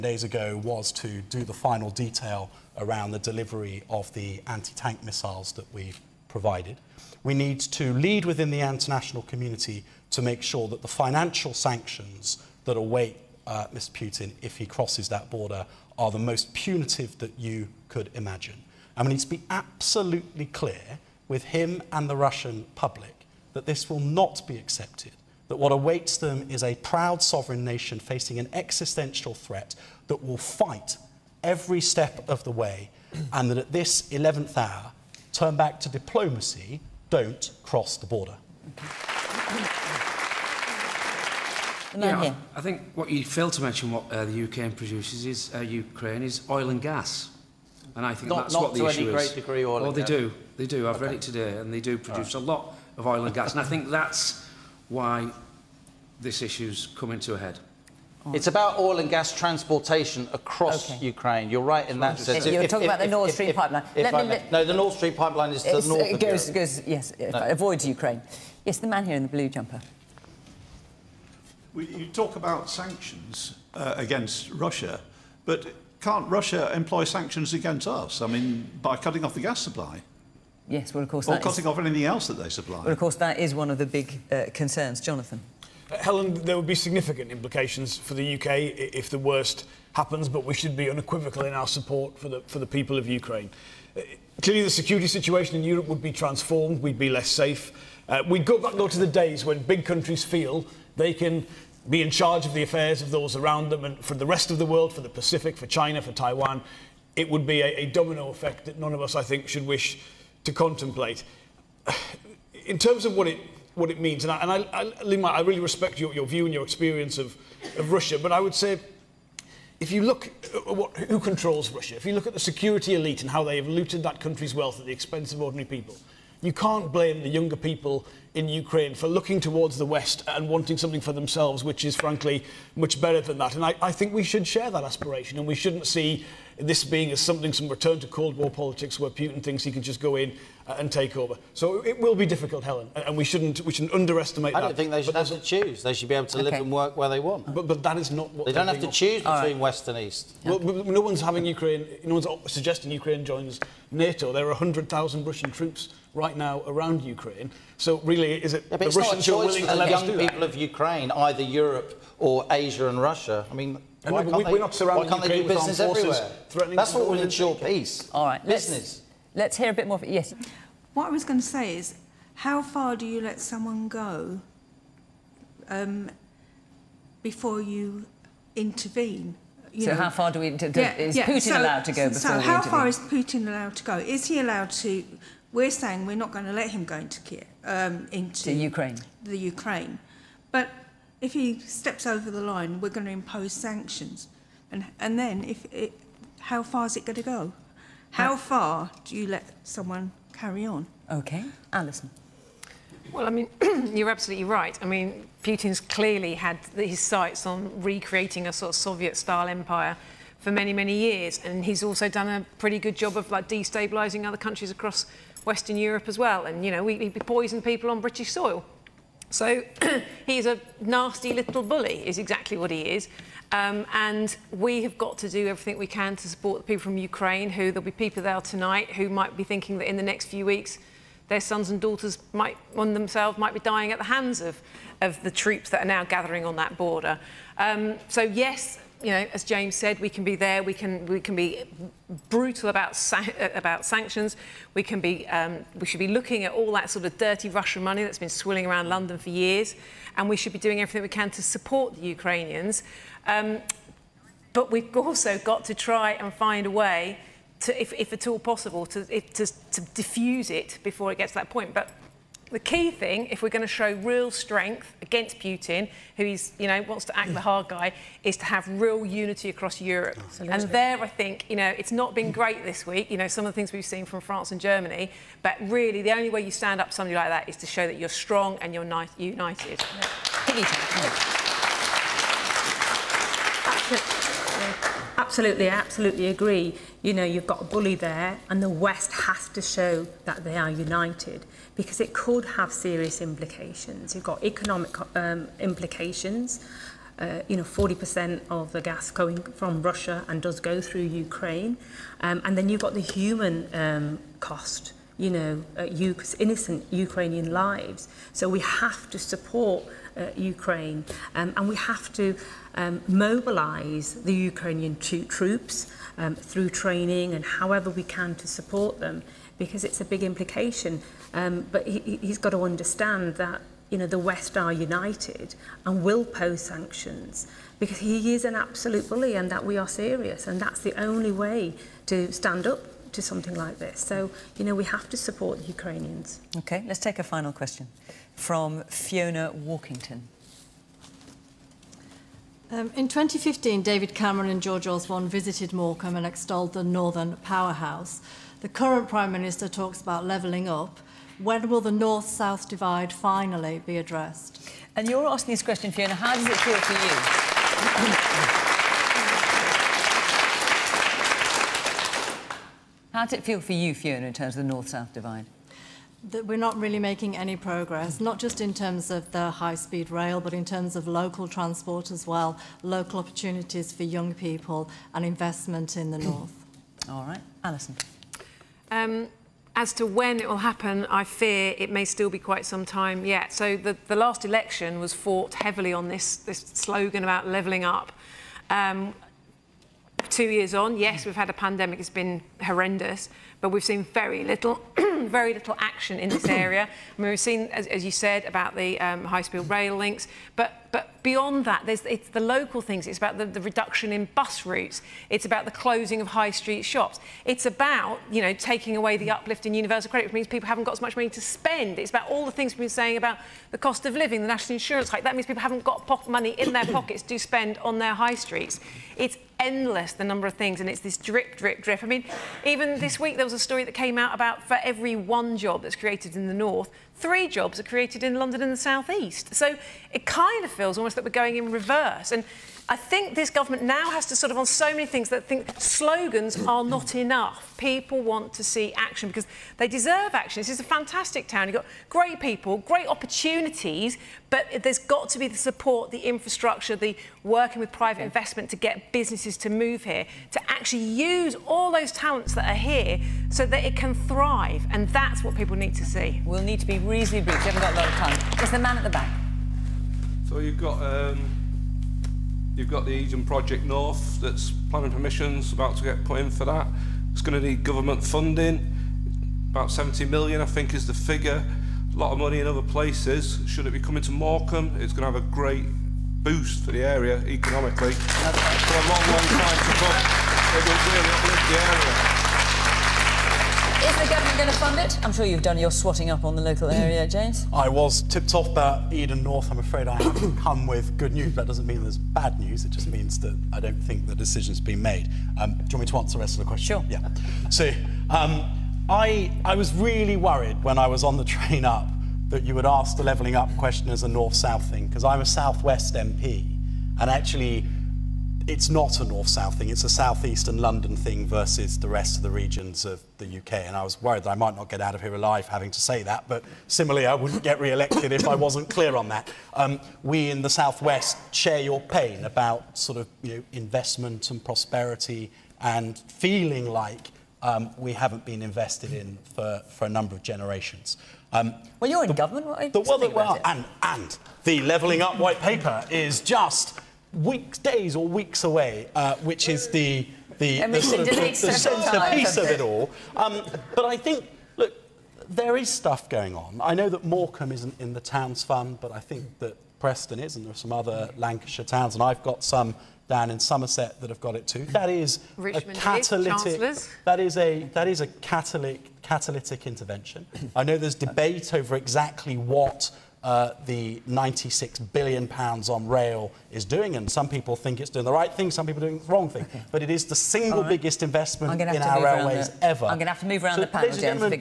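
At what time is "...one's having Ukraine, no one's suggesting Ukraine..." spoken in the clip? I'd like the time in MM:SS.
02:31.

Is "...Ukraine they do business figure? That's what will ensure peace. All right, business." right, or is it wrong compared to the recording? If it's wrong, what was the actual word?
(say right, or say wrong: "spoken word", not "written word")
wrong: "everywhere", not "figure".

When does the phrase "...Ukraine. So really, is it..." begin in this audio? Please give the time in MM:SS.
02:37.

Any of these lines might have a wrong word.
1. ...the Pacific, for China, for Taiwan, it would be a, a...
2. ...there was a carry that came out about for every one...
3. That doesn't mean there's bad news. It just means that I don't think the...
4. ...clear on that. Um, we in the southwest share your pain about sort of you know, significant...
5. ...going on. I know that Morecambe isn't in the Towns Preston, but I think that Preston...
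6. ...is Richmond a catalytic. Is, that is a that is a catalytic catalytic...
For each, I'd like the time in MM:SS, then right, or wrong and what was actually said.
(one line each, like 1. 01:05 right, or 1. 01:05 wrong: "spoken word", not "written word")
1. 01:45 right
2. 07:03 wrong: "story", not "carry"
3. 08:11 right
4. 08:38 wrong: "investment", not "significant"
5. 09:06 wrong: "Fund", not "Preston"
6. 09:15 right.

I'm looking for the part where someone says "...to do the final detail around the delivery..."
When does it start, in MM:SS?
00:00.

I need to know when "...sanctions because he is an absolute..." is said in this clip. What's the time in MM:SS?
05:26.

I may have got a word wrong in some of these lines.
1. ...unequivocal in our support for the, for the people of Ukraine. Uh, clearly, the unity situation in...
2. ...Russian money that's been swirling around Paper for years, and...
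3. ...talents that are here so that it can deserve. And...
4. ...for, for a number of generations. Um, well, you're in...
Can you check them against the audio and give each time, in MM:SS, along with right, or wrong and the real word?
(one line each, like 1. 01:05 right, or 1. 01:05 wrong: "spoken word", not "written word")
1. 01:30 wrong: "security", not "unity"
2. 04:07 wrong: "London", not "Paper"
3. 07:32 wrong: "thrive", not "deserve"
4. 08:49 right.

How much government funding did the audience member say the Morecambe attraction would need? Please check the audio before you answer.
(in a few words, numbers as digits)
70 million.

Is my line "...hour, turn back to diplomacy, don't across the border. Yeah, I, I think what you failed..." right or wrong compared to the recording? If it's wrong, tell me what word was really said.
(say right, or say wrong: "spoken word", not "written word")
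wrong: "cross", not "across".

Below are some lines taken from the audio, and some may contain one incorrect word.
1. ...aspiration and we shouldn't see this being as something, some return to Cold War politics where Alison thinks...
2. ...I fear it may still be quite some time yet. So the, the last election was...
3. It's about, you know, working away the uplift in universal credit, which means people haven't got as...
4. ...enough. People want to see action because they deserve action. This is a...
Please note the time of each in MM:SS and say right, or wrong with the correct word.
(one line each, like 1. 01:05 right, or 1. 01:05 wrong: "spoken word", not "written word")
1. 02:14 wrong: "Putin", not "Alison"
2. 06:21 right
3. 06:47 wrong: "taking", not "working"
4. 07:17 right.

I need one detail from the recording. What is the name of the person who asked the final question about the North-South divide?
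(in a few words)
Fiona Walkington.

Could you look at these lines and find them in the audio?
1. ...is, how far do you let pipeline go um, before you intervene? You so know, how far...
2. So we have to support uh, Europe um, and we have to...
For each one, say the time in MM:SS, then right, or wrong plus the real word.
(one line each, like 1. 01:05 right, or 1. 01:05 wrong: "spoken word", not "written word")
1. 02:51 wrong: "someone", not "pipeline"
2. 05:08 wrong: "Ukraine", not "Europe".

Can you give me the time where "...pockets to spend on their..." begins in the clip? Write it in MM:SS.
06:56.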